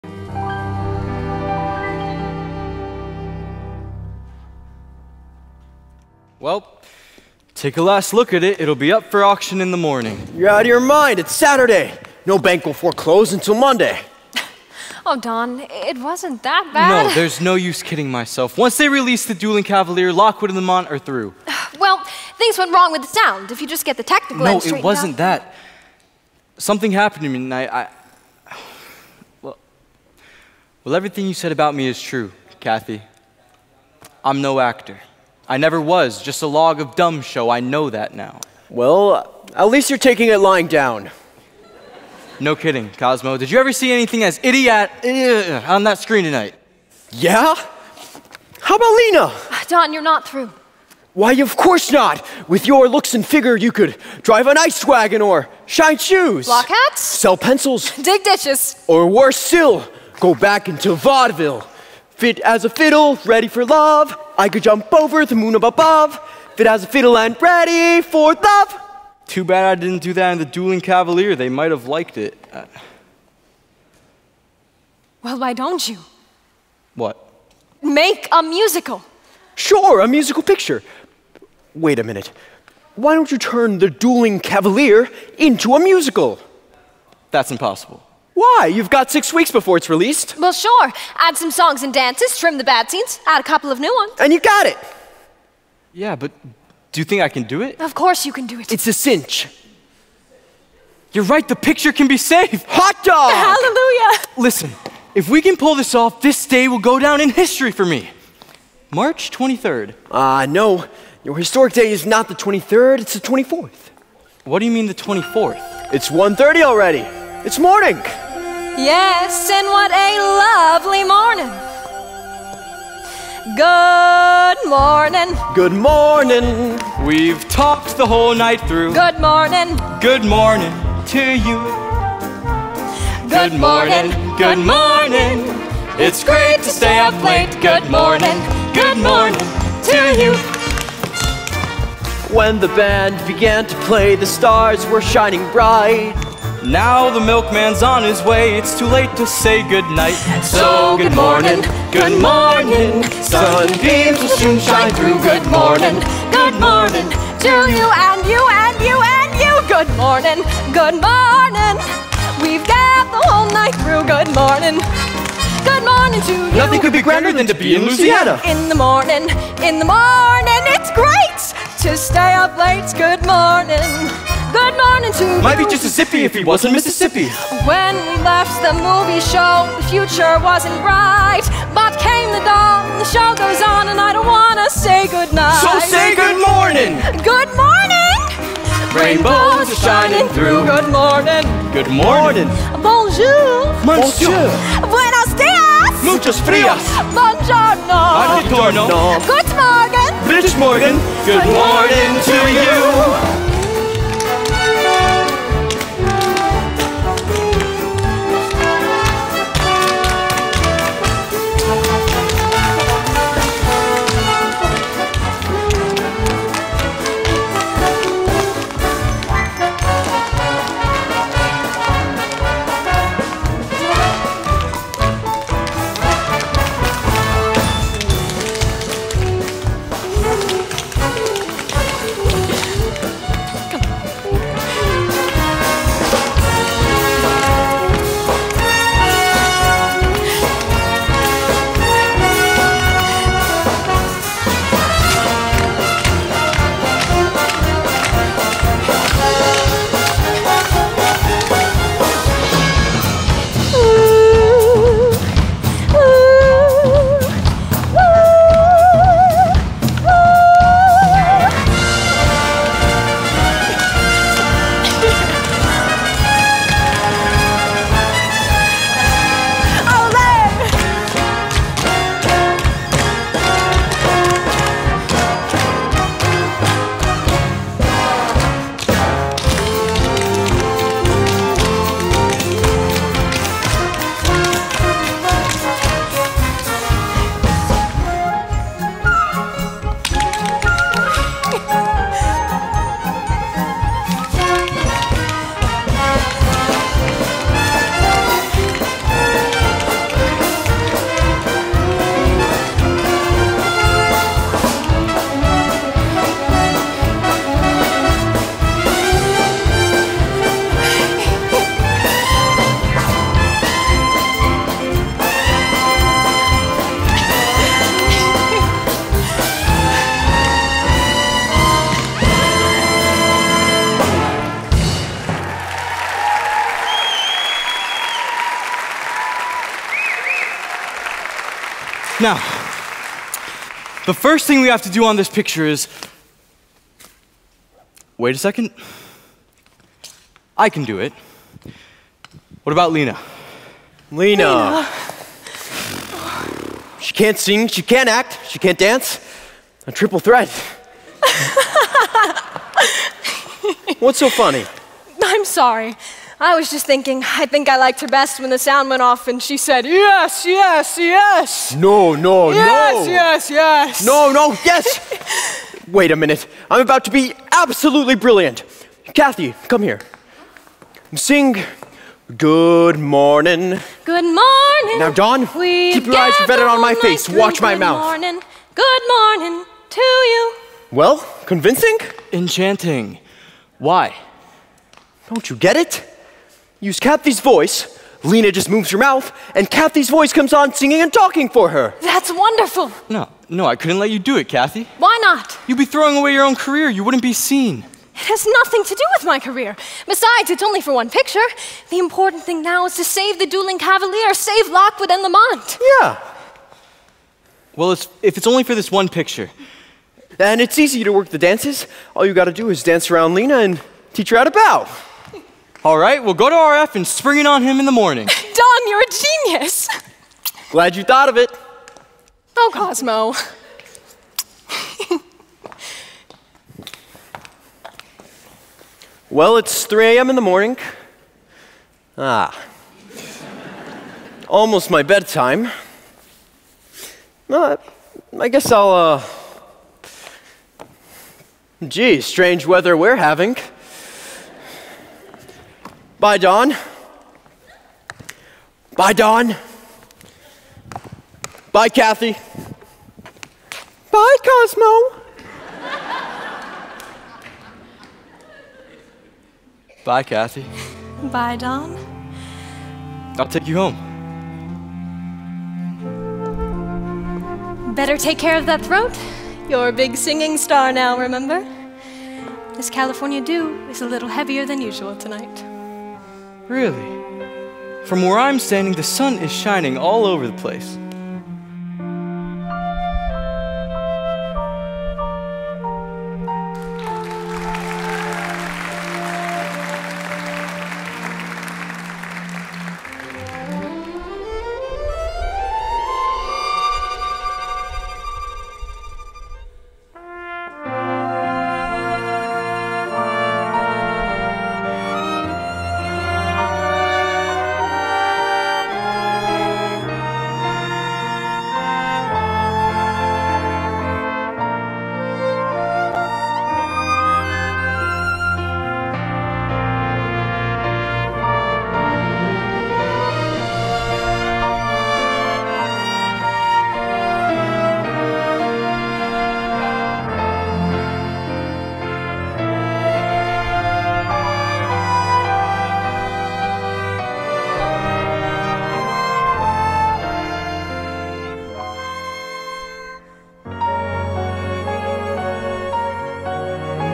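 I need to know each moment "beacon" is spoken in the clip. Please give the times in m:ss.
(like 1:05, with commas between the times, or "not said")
not said.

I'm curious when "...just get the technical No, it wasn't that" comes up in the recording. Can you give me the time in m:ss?
0:23.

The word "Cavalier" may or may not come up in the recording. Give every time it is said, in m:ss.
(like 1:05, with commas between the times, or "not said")
0:19, 1:10, 1:24, 6:43.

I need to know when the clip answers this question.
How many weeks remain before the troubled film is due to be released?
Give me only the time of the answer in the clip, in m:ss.
1:29.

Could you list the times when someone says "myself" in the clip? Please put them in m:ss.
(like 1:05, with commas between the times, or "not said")
0:18.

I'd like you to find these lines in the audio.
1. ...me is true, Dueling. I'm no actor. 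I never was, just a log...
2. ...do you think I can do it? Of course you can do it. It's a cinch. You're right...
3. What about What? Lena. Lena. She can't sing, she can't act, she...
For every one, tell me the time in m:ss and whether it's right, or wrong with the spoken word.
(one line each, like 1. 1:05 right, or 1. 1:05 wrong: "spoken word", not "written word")
1. 0:31 wrong: "Kathy", not "Dueling"
2. 1:36 right
3. 5:42 wrong: "Lena", not "What".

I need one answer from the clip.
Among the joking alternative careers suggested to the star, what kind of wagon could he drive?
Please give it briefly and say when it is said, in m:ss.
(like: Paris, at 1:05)
Ice wagon, at 0:54.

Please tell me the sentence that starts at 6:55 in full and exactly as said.
All right, we'll go to RF and spring it on him in the morning.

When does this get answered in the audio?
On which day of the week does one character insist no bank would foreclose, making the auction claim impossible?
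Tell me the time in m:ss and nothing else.
0:11.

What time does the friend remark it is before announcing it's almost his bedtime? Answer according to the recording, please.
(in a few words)
3 a.m.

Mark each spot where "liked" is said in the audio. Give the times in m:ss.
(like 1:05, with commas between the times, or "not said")
1:11, 5:57.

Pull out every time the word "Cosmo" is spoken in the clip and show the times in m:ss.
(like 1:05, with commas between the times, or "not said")
0:42, 7:02, 7:34.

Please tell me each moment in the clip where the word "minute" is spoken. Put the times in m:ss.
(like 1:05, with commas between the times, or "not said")
1:22, 6:06.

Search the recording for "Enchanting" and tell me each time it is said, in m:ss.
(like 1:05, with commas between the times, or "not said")
6:22.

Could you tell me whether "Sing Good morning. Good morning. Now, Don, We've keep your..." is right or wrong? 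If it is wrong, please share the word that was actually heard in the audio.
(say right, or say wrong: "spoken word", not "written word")
right.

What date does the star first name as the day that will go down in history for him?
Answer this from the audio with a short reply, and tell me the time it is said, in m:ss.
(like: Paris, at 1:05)
March 23rd, at 1:48.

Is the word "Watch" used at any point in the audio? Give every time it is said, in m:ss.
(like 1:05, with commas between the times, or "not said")
6:17.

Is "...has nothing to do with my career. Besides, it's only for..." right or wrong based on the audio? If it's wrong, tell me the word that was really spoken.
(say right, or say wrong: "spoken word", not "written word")
right.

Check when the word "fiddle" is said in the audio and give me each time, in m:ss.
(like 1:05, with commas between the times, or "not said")
1:02, 1:06.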